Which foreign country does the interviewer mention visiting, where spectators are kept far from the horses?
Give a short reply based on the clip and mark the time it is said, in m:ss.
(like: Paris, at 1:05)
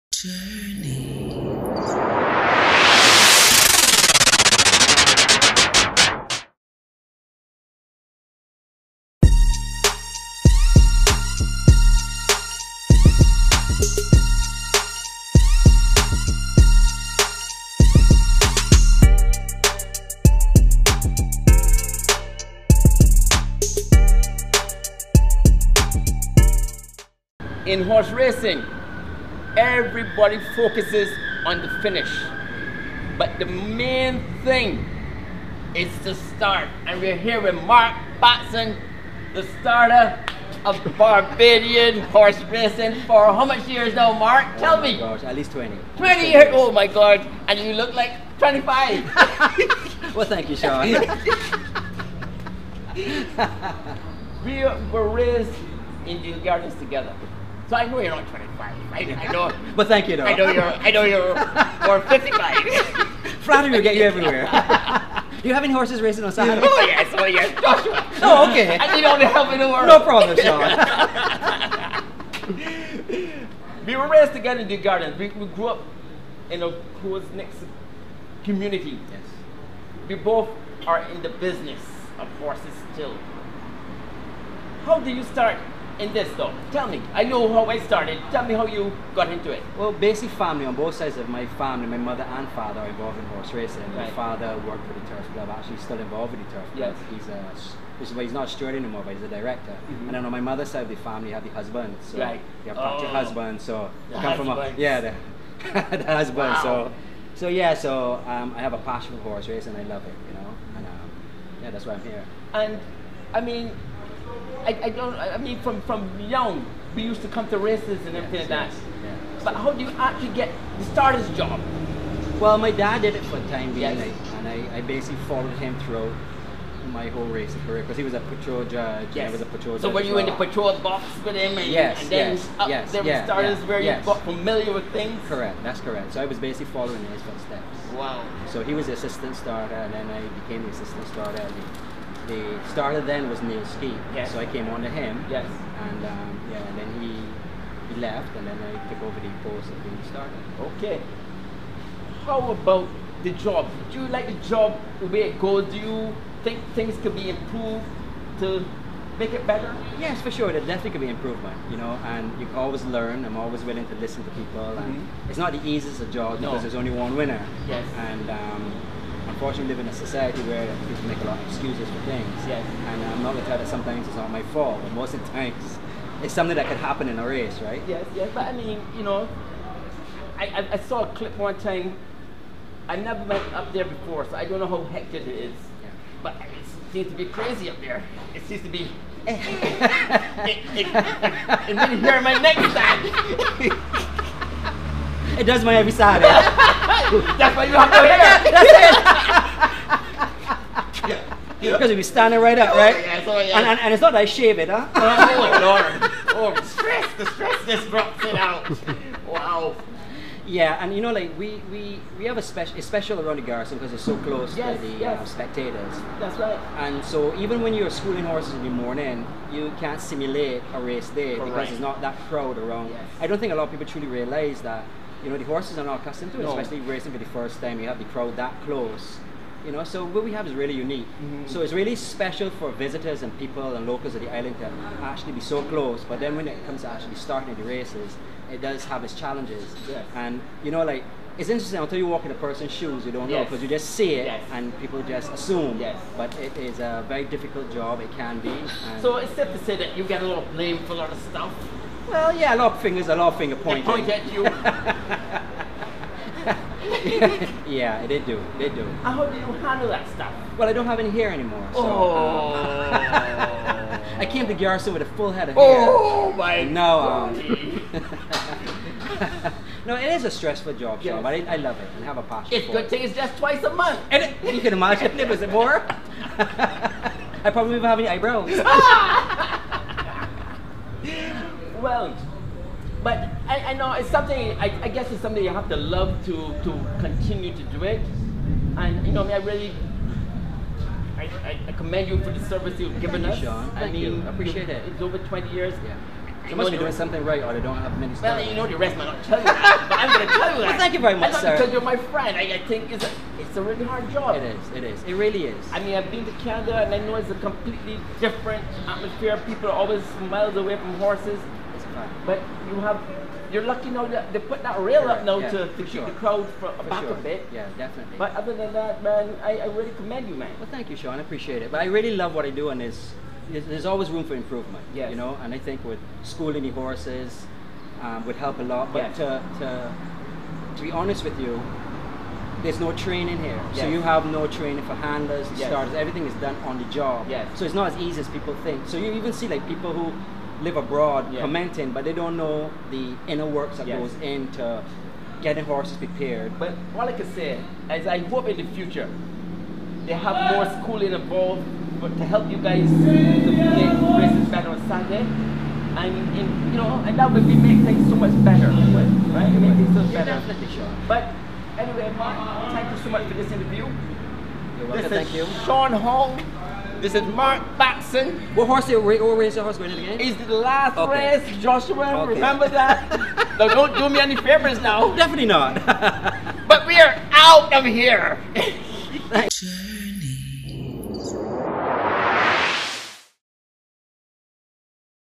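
Canada, at 5:06.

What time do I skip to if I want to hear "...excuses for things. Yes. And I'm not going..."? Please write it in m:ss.
2:51.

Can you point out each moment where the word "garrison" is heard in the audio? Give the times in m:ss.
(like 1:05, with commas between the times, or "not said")
3:33, 4:24.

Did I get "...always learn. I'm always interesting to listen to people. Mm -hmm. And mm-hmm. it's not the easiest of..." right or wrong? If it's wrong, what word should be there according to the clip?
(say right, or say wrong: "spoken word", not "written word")
wrong: "willing", not "interesting".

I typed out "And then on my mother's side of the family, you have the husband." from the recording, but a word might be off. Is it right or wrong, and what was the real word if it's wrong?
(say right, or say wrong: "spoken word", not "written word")
right.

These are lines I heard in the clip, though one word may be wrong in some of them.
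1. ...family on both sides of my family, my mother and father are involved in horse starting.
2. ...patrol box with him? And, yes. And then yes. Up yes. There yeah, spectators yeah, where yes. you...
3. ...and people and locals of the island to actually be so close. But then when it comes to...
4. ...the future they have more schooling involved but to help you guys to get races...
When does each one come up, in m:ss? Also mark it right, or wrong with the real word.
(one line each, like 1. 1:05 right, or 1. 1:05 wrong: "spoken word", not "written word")
1. 1:30 wrong: "racing", not "starting"
2. 2:10 wrong: "starters", not "spectators"
3. 3:53 right
4. 5:48 right.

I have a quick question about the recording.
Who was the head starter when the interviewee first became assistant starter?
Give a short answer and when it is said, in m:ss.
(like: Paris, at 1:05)
Neil Ski, at 2:23.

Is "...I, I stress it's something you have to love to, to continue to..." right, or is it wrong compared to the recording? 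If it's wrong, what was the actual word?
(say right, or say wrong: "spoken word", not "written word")
wrong: "guess", not "stress".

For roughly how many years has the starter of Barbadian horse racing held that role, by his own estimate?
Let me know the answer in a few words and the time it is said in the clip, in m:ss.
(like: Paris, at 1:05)
20, at 0:45.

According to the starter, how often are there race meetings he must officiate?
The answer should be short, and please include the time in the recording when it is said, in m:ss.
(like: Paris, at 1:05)
Twice a month, at 4:33.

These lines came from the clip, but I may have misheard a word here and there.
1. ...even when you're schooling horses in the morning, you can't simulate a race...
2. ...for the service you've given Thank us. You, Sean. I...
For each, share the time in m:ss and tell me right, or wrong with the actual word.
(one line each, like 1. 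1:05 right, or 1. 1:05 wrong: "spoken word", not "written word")
1. 3:37 right
2. 4:52 right.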